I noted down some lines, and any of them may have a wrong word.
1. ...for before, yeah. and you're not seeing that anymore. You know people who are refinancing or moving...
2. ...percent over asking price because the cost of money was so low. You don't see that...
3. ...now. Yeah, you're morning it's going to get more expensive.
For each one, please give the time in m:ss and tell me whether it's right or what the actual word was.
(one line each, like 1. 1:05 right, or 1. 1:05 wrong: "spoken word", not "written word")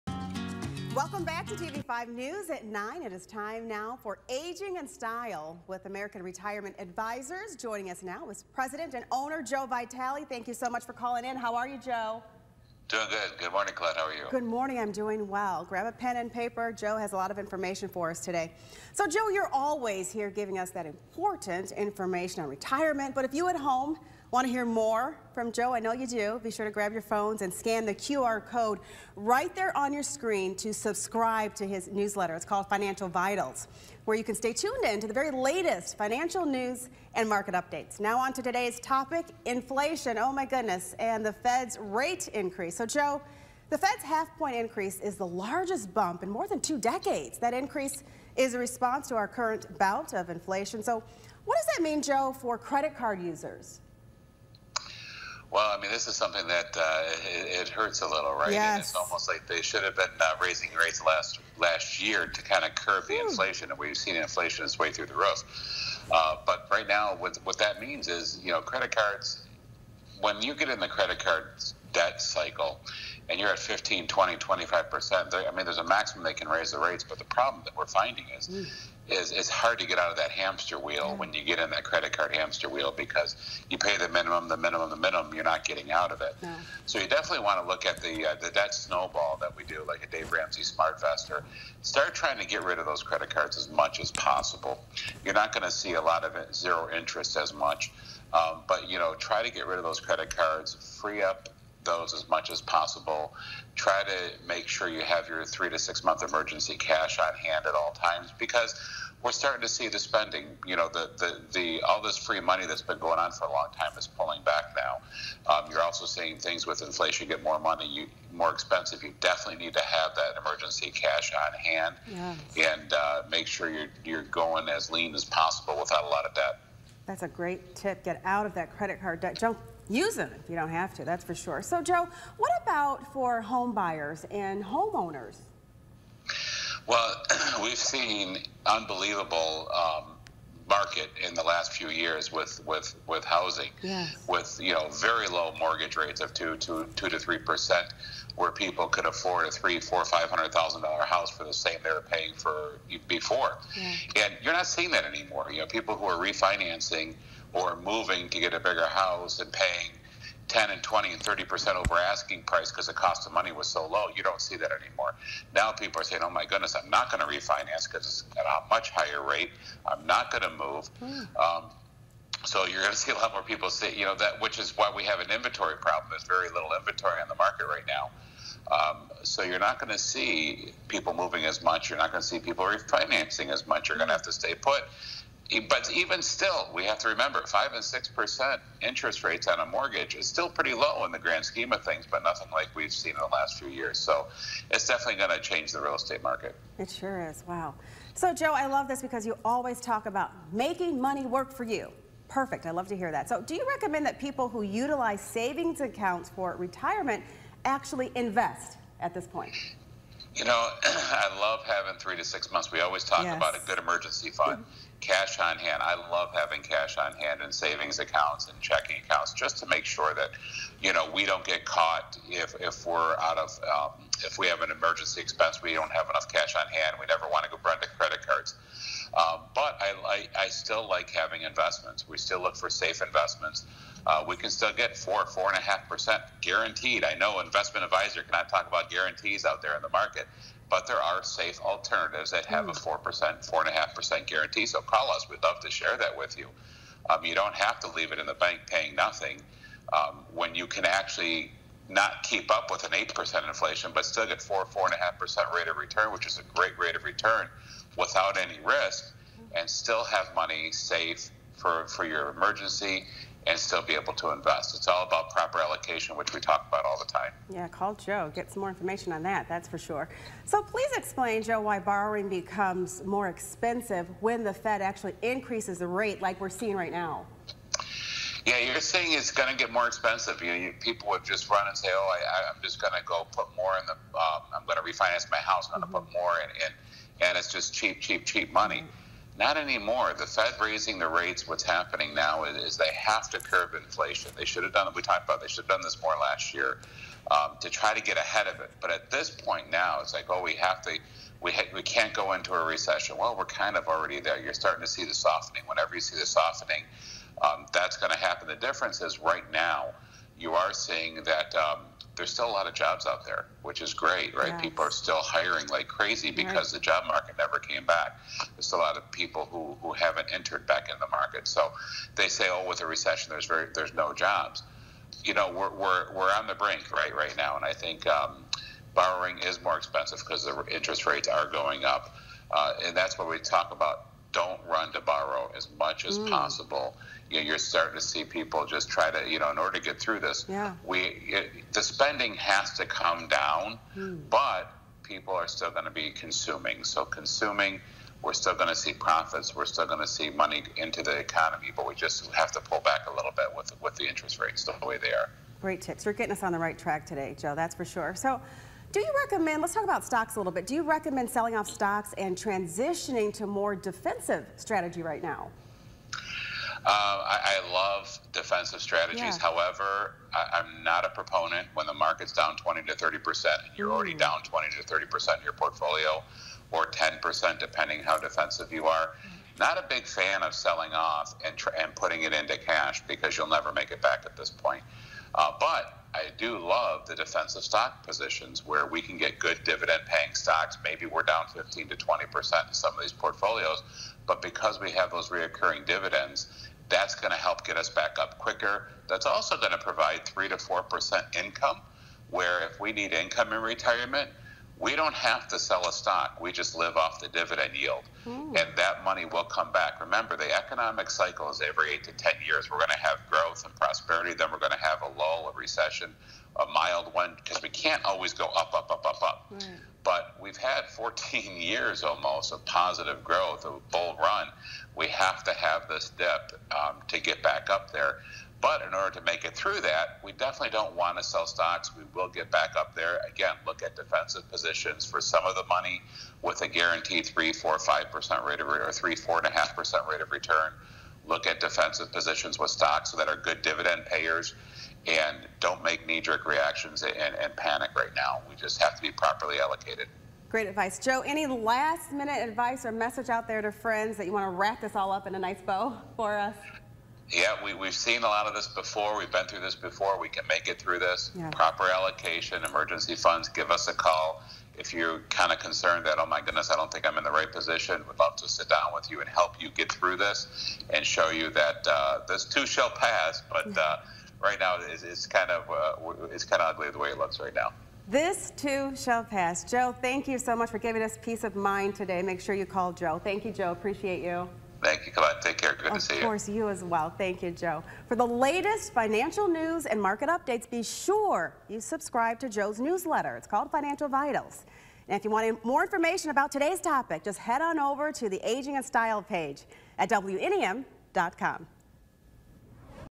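1. 2:32 right
2. 2:41 right
3. 4:36 wrong: "saying", not "morning".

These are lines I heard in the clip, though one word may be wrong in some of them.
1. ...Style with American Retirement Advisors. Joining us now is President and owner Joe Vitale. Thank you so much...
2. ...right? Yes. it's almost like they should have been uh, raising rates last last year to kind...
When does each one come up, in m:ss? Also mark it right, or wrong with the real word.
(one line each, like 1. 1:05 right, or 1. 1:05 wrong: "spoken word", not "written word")
1. 0:04 right
2. 0:58 right.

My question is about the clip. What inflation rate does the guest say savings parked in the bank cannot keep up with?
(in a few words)
8 percent.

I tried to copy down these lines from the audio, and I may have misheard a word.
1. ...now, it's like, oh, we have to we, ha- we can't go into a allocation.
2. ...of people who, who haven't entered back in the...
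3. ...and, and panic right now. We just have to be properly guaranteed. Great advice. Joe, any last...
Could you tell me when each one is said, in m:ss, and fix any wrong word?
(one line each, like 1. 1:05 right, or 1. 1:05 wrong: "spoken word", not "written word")
1. 4:59 wrong: "recession", not "allocation"
2. 5:18 right
3. 7:27 wrong: "allocated", not "guaranteed".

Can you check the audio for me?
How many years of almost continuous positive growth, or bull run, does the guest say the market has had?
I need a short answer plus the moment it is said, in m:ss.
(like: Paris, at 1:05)
14, at 7:00.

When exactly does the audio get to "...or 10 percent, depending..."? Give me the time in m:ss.
6:16.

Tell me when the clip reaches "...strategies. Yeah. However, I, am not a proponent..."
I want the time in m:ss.
6:08.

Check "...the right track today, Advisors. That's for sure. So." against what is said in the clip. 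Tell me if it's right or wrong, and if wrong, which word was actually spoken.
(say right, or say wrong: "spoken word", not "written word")
wrong: "Joe", not "Advisors".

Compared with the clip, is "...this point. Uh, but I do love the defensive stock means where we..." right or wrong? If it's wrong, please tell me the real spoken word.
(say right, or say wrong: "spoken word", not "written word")
wrong: "positions", not "means".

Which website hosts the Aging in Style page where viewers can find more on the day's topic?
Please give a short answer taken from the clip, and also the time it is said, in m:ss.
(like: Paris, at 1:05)
WNEM.com, at 8:20.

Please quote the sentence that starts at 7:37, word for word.
yeah, we, we've seen a lot of this before.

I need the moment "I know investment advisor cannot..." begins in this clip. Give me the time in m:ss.
3:57.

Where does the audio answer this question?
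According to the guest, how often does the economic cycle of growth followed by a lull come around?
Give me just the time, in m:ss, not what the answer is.
6:51.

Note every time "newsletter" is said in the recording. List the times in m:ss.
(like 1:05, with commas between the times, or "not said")
0:31, 8:12.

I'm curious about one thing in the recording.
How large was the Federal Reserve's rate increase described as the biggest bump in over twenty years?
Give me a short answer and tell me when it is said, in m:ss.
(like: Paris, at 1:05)
half-point, at 0:44.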